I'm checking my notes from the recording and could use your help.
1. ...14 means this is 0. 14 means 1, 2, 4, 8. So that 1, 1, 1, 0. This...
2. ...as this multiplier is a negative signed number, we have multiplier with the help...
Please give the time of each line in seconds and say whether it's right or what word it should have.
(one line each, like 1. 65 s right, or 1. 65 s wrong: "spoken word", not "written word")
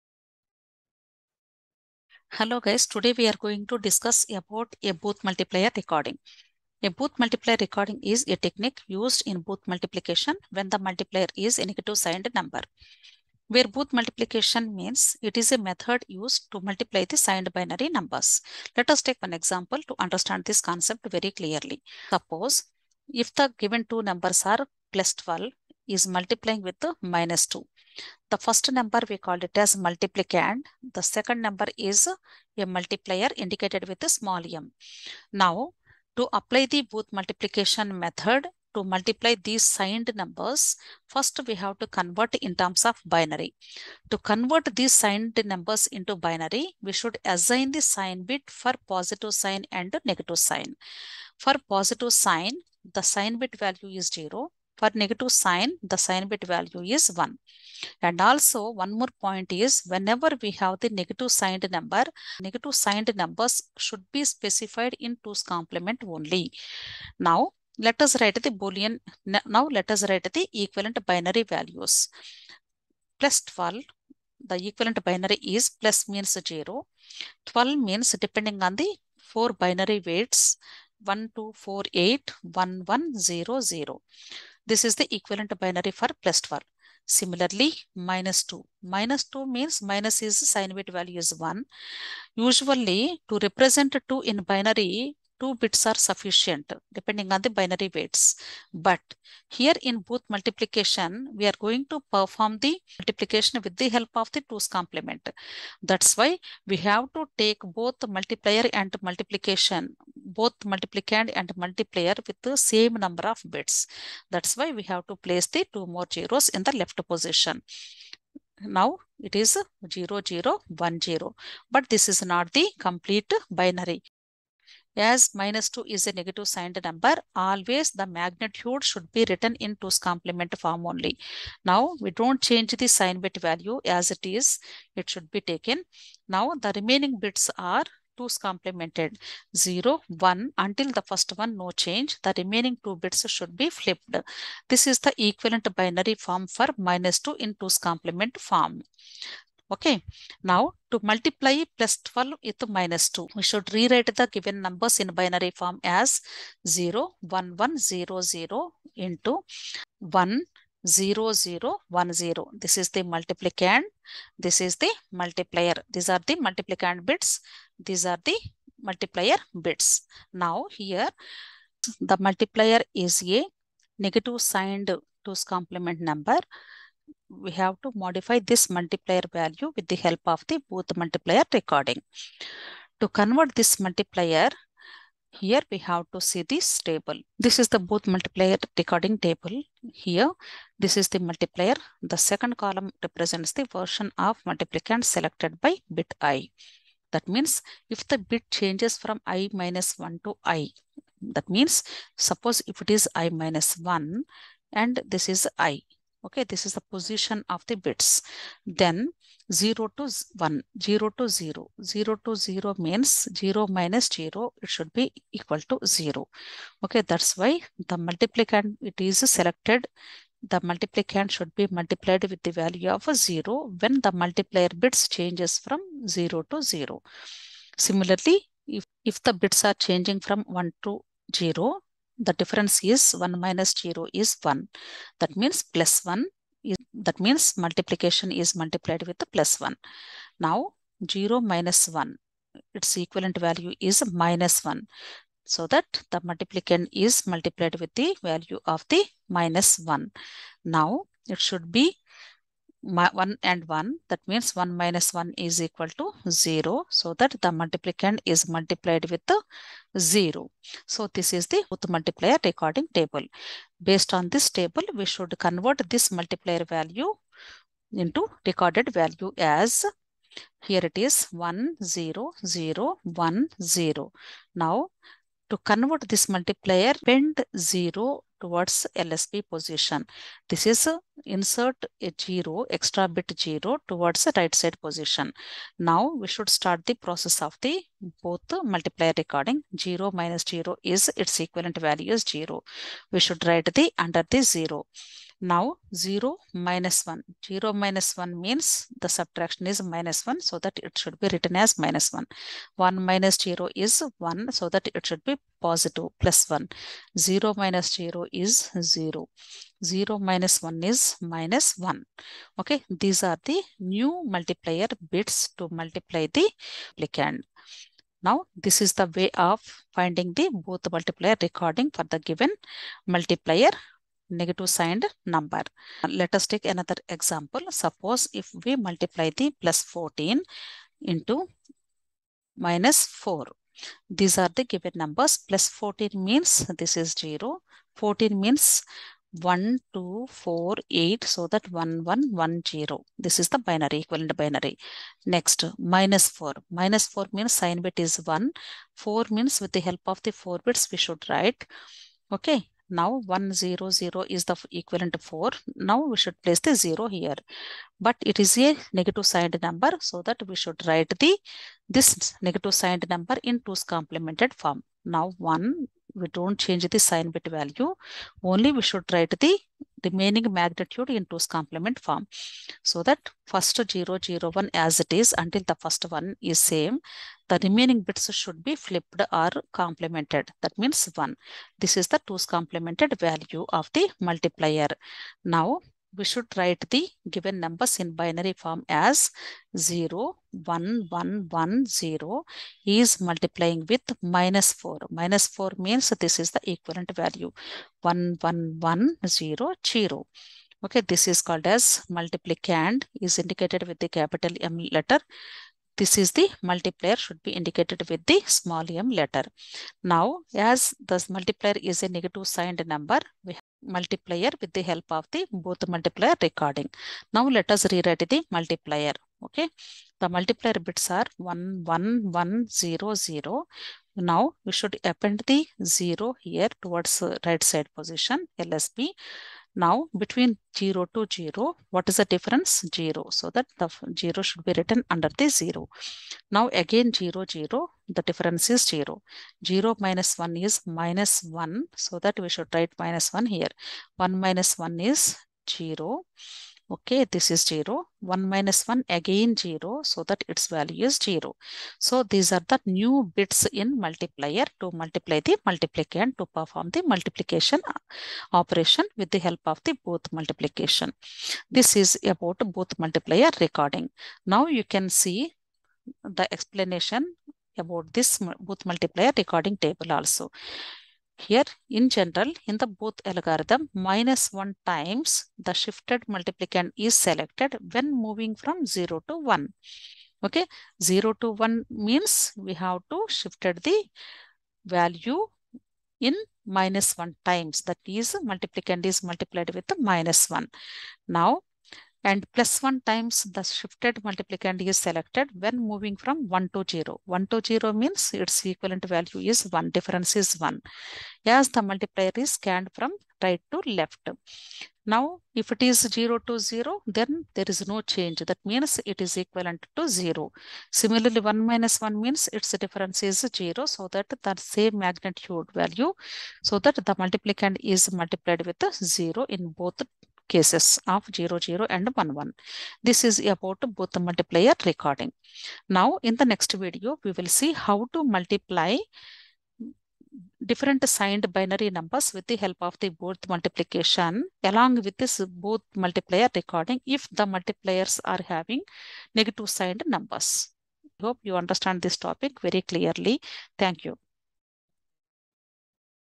1. 335 s right
2. 410 s right.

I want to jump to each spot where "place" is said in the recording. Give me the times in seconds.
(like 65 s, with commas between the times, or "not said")
115 s, 356 s.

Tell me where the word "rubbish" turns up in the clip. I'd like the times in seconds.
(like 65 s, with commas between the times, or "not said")
not said.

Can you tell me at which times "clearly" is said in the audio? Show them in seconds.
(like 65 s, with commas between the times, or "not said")
21 s, 542 s.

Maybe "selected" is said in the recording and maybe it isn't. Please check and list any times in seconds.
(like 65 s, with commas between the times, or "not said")
195 s, 219 s, 477 s, 494 s.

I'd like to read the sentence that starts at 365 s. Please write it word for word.
Now 1, we don't change the sign bit value.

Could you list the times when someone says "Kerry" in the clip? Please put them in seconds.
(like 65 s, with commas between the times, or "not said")
not said.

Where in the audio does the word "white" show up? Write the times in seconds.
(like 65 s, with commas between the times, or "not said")
not said.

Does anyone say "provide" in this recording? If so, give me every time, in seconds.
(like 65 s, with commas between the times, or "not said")
not said.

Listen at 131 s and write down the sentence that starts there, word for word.
Now, we don't change the sign bit value as it is.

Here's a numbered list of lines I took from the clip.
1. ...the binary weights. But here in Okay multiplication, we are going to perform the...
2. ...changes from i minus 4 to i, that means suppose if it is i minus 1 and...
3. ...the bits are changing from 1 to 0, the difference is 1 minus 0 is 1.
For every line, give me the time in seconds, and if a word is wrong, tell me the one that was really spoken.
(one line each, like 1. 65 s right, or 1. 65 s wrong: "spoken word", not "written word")
1. 97 s wrong: "Booth", not "Okay"
2. 198 s wrong: "1", not "4"
3. 229 s right.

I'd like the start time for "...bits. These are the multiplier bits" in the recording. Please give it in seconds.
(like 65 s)
167 s.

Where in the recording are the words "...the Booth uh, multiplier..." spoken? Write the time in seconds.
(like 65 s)
287 s.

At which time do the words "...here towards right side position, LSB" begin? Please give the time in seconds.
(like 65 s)
426 s.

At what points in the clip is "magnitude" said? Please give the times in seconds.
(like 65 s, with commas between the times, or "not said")
128 s, 370 s, 514 s.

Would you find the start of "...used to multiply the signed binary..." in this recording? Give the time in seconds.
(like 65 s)
16 s.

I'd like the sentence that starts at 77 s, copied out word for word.
12 means depending on the 4 binary weights, 1, 2, 4, 8, 1, 1, 0, 0.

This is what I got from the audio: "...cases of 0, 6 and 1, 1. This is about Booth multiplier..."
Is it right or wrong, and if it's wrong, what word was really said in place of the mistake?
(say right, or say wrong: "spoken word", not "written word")
wrong: "0", not "6".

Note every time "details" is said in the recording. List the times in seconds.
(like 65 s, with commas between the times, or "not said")
not said.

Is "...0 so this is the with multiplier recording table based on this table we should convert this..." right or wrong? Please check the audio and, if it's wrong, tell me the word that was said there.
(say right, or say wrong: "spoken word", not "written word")
right.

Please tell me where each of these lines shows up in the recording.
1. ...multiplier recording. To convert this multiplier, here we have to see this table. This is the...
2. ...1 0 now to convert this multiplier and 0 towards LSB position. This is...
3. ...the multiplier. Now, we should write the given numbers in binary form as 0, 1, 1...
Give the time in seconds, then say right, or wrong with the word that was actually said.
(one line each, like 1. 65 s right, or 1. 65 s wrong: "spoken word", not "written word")
1. 180 s right
2. 273 s right
3. 383 s right.